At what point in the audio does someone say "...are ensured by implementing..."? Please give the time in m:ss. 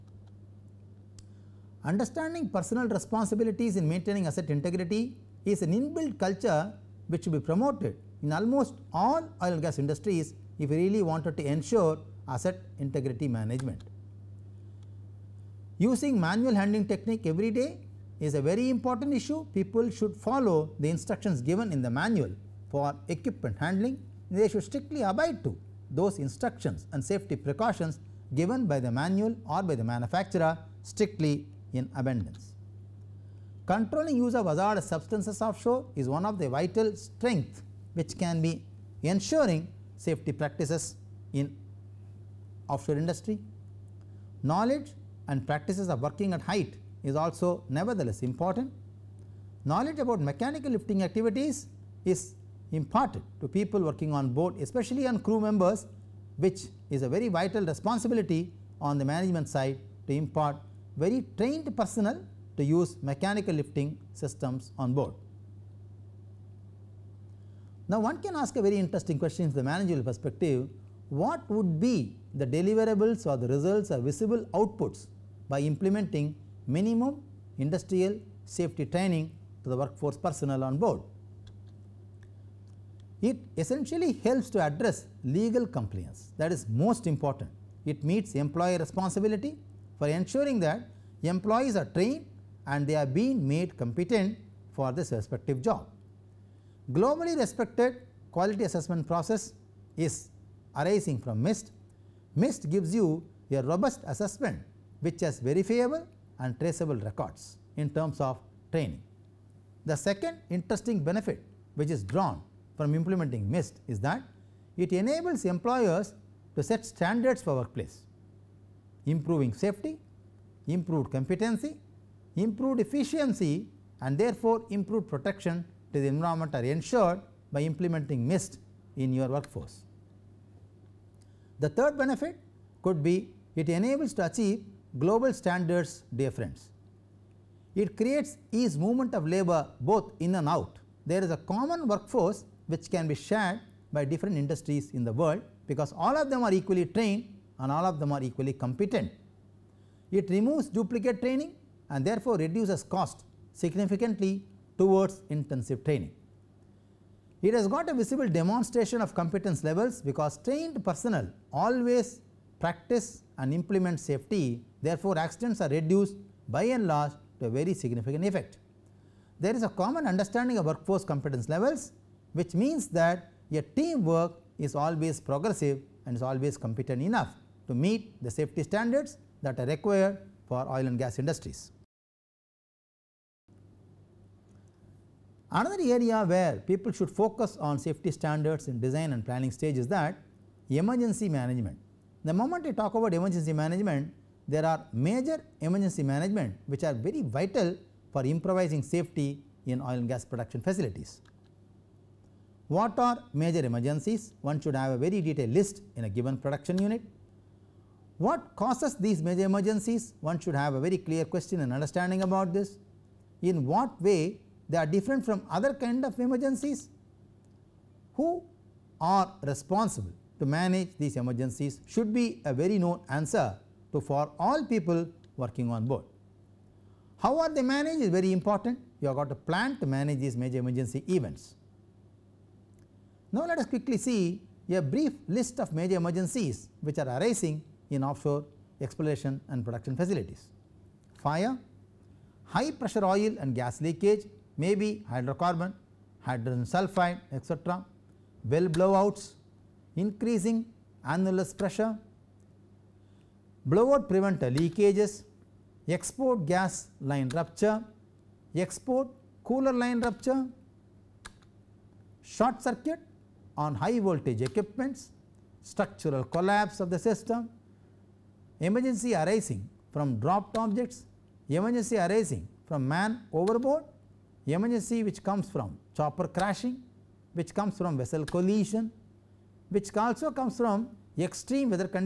2:06.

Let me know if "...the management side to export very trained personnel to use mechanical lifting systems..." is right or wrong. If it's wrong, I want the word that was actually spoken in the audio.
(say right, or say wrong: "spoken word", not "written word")
wrong: "impart", not "export".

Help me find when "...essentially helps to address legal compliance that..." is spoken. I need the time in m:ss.
1:23.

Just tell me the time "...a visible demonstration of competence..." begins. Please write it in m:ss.
2:37.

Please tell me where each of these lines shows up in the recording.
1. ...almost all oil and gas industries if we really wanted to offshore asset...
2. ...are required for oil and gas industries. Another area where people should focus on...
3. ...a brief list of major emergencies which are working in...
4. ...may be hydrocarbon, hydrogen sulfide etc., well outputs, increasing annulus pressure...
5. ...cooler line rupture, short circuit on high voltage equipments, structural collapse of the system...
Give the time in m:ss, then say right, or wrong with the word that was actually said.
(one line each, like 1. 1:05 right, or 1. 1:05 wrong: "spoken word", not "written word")
1. 0:08 wrong: "ensure", not "offshore"
2. 2:59 right
3. 3:54 wrong: "arising", not "working"
4. 4:04 wrong: "blowouts", not "outputs"
5. 4:19 right.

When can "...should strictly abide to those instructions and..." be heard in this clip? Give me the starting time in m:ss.
0:24.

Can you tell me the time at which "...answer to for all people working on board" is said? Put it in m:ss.
3:43.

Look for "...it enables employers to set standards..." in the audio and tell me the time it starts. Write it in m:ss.
1:54.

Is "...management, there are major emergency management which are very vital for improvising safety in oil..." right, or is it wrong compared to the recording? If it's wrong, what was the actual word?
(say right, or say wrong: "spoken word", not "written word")
right.